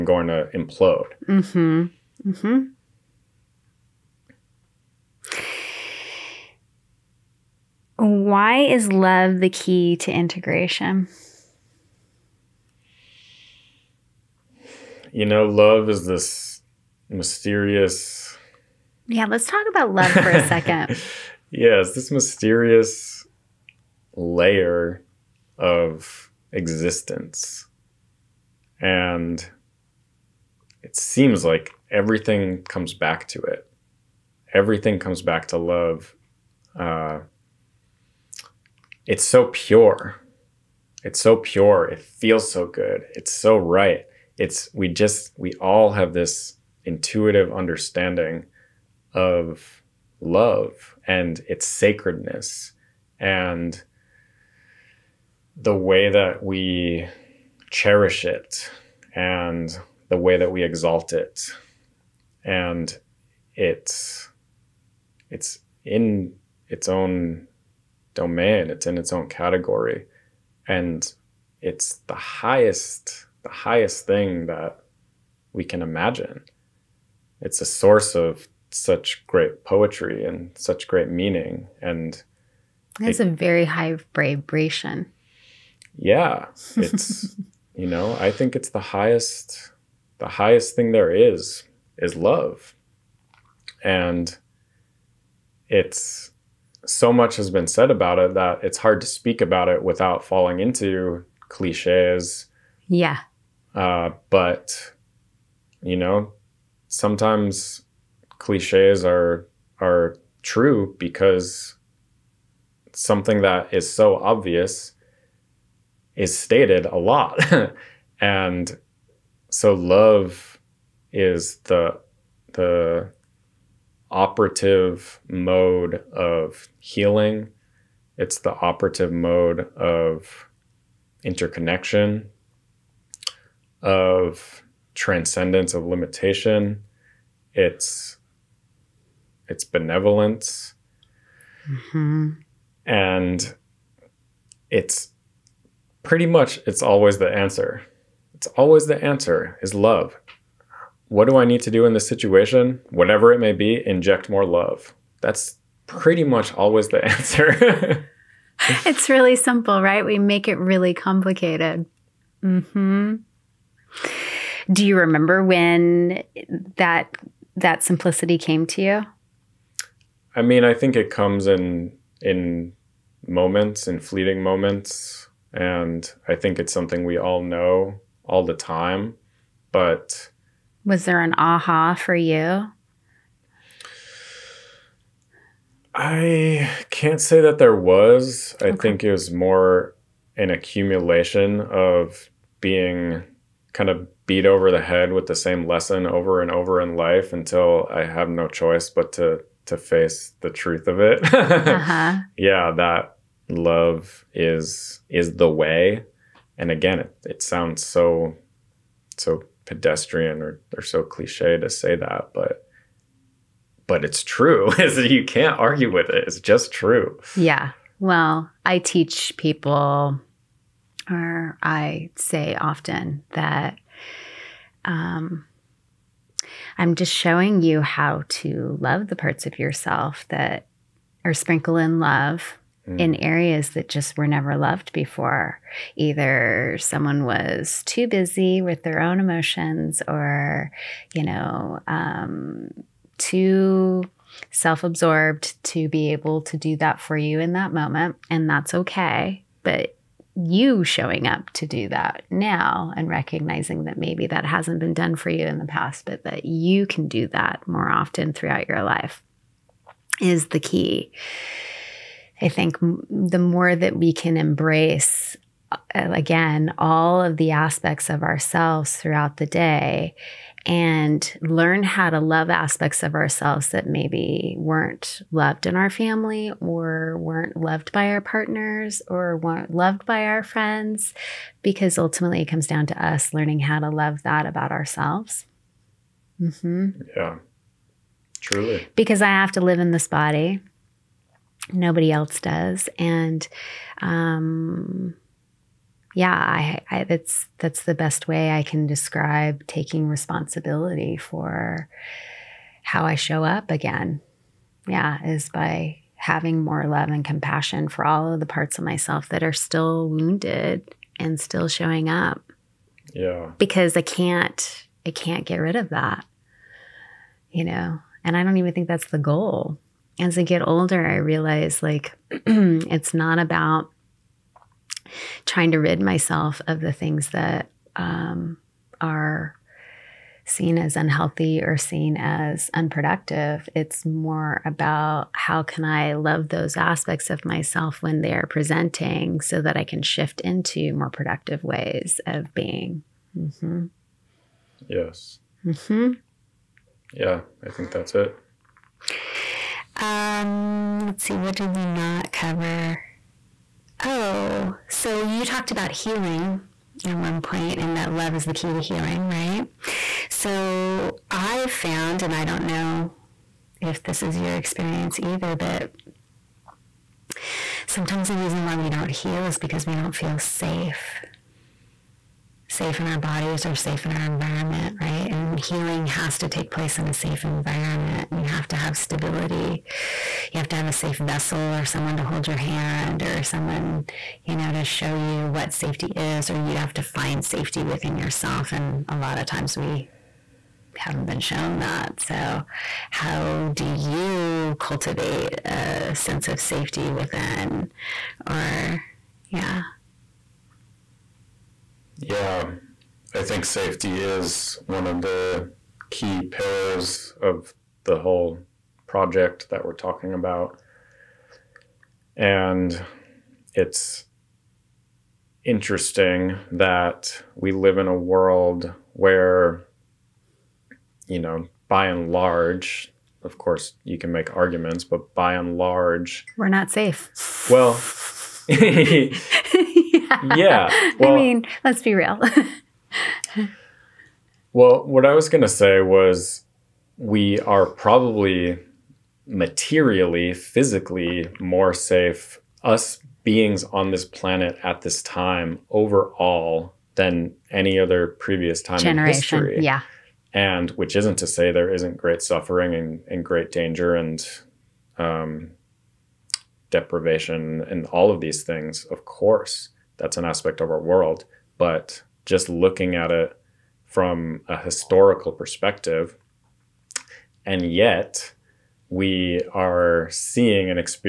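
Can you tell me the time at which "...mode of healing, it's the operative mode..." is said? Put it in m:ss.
2:05.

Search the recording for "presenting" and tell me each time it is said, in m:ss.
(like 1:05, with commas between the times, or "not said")
5:38.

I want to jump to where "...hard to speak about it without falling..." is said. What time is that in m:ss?
1:38.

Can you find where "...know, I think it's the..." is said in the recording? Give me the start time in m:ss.
1:27.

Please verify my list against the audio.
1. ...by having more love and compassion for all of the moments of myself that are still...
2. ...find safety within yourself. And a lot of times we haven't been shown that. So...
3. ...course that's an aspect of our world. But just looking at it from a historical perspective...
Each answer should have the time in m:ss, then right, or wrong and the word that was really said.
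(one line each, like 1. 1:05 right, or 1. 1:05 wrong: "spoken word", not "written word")
1. 5:05 wrong: "parts", not "moments"
2. 6:27 right
3. 7:39 right.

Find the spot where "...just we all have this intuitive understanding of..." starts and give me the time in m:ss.
0:44.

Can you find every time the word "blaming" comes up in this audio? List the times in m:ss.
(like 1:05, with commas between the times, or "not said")
not said.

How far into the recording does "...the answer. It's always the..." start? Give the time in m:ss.
2:27.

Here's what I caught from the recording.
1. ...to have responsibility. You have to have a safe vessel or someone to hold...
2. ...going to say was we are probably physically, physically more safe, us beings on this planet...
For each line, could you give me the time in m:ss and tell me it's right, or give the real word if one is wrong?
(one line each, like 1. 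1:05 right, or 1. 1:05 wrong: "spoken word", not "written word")
1. 6:18 wrong: "stability", not "responsibility"
2. 7:15 wrong: "materially", not "physically".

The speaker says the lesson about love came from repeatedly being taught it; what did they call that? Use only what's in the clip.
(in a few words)
An accumulation.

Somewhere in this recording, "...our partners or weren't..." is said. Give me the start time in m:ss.
4:38.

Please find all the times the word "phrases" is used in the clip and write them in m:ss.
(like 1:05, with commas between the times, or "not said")
not said.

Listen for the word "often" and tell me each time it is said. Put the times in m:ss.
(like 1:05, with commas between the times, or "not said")
3:42, 4:17.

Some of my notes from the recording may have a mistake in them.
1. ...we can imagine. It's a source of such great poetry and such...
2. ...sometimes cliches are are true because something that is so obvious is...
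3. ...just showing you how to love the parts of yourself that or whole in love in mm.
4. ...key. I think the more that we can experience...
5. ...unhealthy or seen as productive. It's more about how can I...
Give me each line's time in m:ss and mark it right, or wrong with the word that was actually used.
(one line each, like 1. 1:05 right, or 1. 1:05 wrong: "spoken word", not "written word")
1. 1:15 right
2. 1:46 right
3. 3:46 wrong: "sprinkle", not "whole"
4. 4:20 wrong: "embrace", not "experience"
5. 5:30 wrong: "unproductive", not "productive".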